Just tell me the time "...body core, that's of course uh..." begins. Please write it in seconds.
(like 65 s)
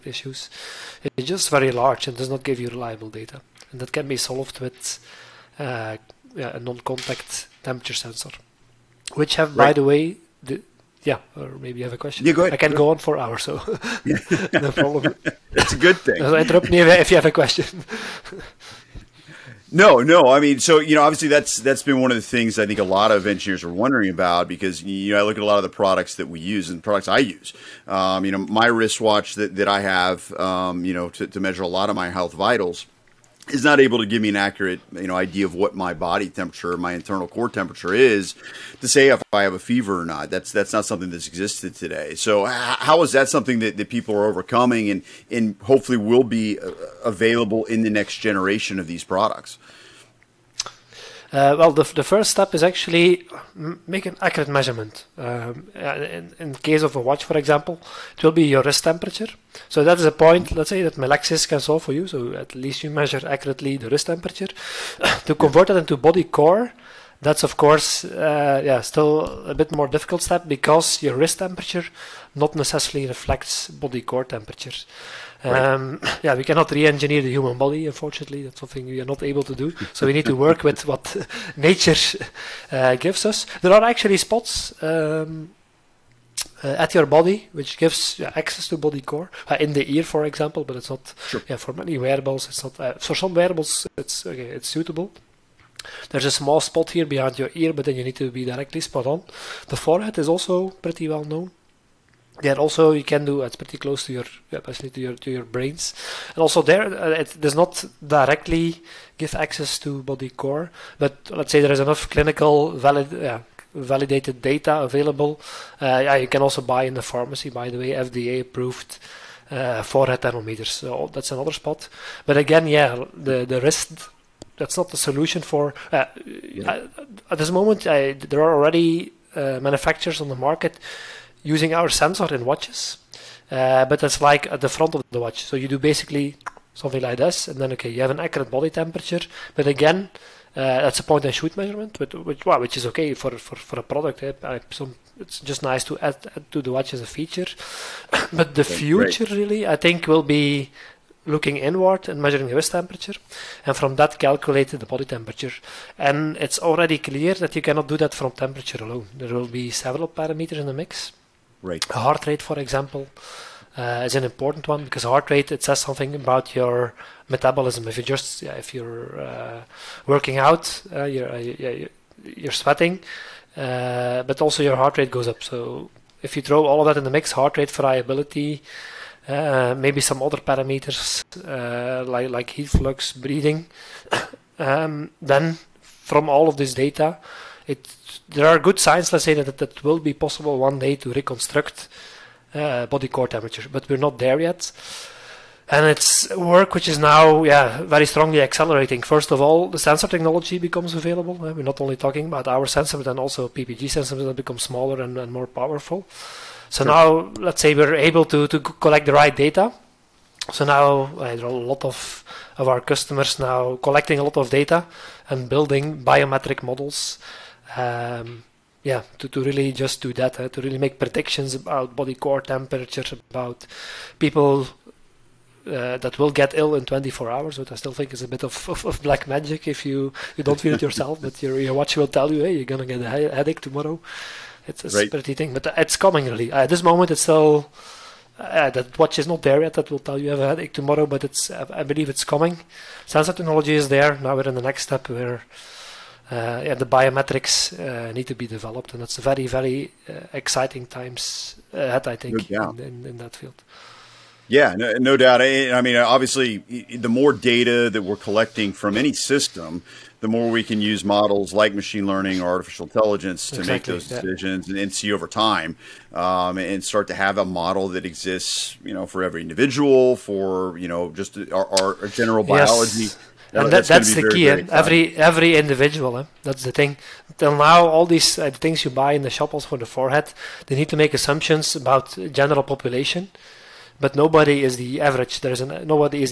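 65 s.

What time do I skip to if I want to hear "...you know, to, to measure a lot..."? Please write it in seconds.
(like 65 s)
30 s.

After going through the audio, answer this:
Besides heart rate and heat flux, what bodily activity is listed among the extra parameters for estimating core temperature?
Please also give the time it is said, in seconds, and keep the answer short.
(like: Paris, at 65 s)
Breathing, at 183 s.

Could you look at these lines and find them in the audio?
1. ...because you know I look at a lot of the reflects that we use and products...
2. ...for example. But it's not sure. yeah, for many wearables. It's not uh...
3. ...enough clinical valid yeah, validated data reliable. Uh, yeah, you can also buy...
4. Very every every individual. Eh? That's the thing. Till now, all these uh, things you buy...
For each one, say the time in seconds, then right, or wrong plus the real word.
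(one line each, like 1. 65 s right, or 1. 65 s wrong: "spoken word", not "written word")
1. 24 s wrong: "products", not "reflects"
2. 90 s right
3. 111 s wrong: "available", not "reliable"
4. 274 s right.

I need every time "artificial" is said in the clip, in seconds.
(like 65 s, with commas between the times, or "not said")
262 s.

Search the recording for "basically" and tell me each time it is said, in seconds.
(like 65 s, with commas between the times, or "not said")
104 s, 135 s.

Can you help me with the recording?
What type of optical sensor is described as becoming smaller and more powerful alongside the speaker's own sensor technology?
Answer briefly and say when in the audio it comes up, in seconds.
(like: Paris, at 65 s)
PPG sensors, at 203 s.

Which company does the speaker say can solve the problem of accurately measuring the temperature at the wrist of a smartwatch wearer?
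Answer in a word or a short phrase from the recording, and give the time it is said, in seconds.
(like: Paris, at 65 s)
Melexis, at 60 s.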